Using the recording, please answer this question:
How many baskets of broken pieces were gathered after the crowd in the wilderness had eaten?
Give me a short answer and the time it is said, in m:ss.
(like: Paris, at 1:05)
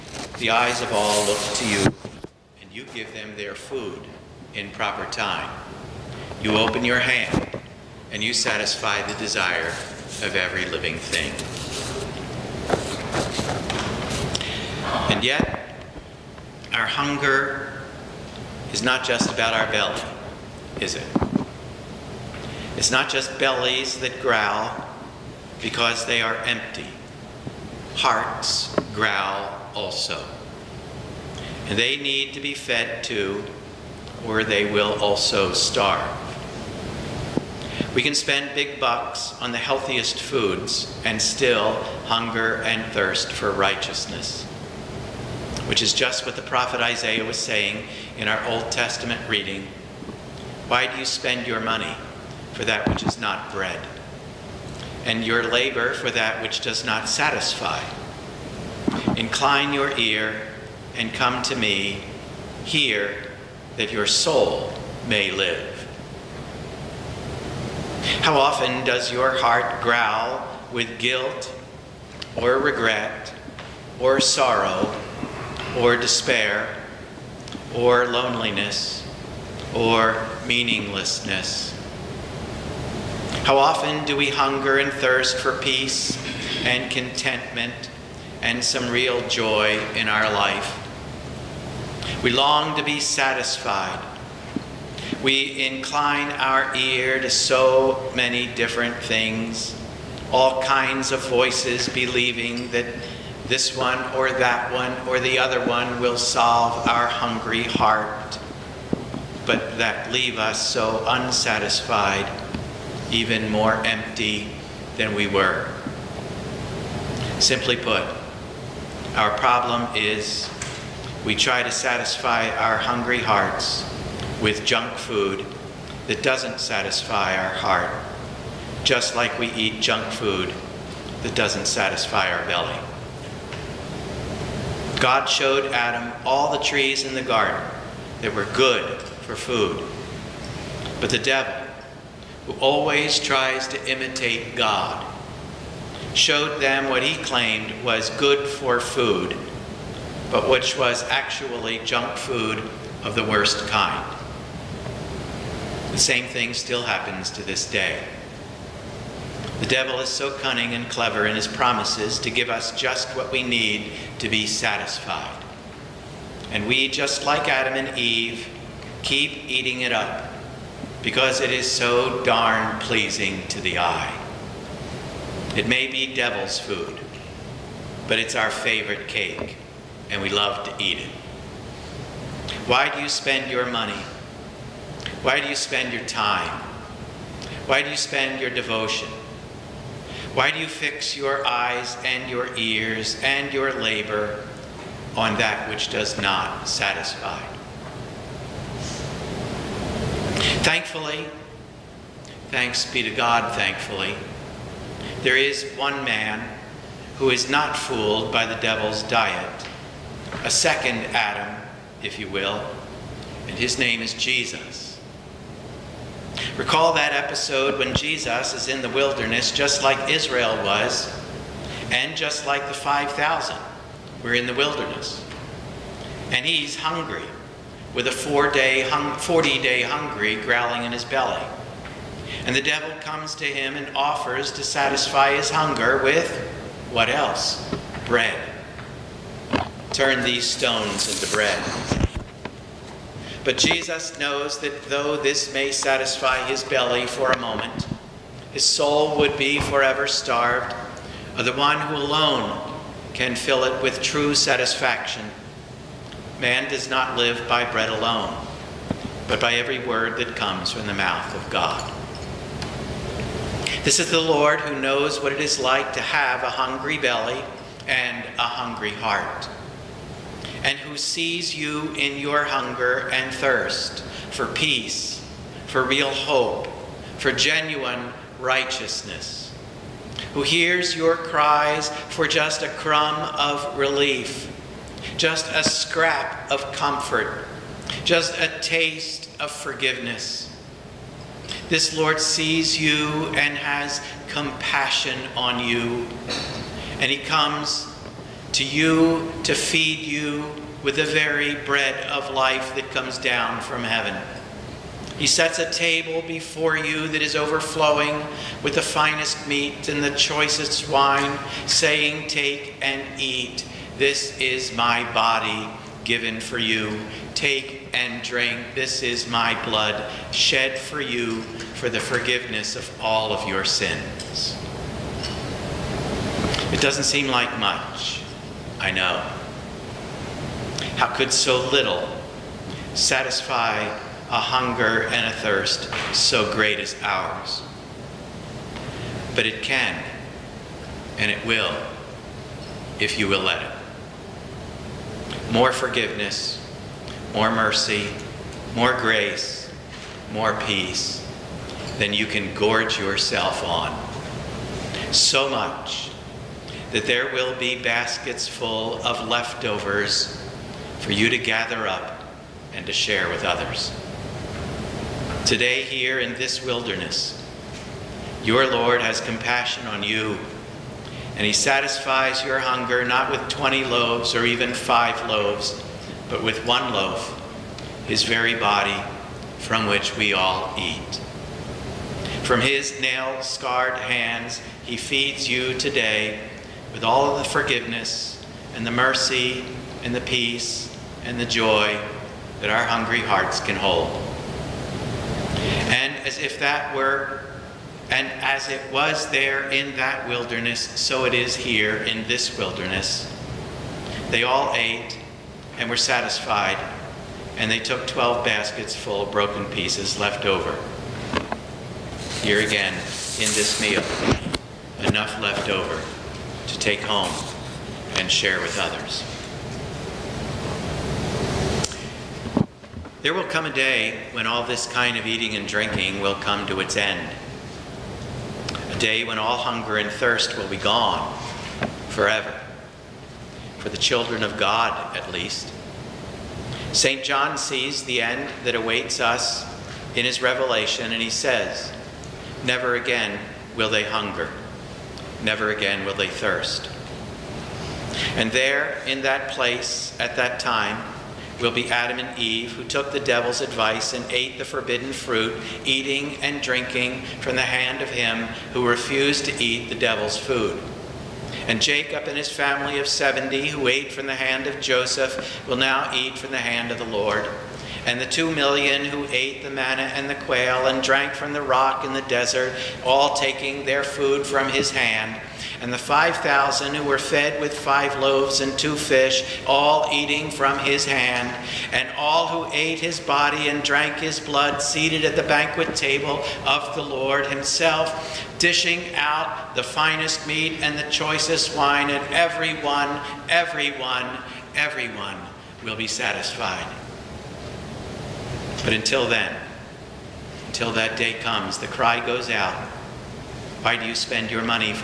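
12, at 6:48.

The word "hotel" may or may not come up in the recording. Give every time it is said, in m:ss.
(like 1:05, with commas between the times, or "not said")
not said.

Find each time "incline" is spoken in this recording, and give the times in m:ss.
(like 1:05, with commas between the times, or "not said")
0:59, 1:35.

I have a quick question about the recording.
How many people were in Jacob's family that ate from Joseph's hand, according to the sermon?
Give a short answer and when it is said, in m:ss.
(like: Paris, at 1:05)
70, at 7:43.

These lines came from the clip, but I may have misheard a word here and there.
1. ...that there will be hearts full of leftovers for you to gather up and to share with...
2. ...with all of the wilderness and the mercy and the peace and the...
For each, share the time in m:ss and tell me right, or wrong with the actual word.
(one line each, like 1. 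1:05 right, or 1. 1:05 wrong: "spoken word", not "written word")
1. 5:56 wrong: "baskets", not "hearts"
2. 6:26 wrong: "forgiveness", not "wilderness".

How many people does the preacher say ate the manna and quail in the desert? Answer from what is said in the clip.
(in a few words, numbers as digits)
2 million.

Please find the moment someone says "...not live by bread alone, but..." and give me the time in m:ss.
4:16.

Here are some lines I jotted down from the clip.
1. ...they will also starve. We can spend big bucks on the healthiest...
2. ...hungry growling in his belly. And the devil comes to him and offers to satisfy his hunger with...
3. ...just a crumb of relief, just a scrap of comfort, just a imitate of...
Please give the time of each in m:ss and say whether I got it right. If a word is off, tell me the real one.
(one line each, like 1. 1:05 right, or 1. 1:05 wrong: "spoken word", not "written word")
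1. 0:34 right
2. 3:49 right
3. 4:42 wrong: "taste", not "imitate".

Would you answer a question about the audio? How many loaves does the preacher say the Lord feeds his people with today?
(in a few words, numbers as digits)
1.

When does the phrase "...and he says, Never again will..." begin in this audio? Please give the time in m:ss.
7:21.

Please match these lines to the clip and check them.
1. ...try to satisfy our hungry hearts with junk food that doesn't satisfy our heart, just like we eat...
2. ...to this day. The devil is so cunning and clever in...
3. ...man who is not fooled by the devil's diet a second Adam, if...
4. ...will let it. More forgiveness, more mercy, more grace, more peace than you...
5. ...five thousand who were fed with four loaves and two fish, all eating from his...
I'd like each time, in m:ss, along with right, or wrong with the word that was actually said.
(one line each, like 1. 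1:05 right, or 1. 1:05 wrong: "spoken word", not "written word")
1. 2:01 right
2. 2:37 right
3. 3:26 right
4. 5:43 right
5. 7:55 wrong: "five", not "four".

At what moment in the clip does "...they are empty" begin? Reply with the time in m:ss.
0:26.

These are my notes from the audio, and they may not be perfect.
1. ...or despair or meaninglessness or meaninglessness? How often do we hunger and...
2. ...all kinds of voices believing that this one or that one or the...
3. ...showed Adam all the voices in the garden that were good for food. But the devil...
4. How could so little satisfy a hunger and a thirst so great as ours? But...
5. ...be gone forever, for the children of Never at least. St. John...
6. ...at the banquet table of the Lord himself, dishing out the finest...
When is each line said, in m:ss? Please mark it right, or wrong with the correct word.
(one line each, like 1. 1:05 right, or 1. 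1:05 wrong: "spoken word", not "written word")
1. 1:15 wrong: "loneliness", not "meaninglessness"
2. 1:40 right
3. 2:15 wrong: "trees", not "voices"
4. 5:30 right
5. 7:10 wrong: "God", not "Never"
6. 8:05 right.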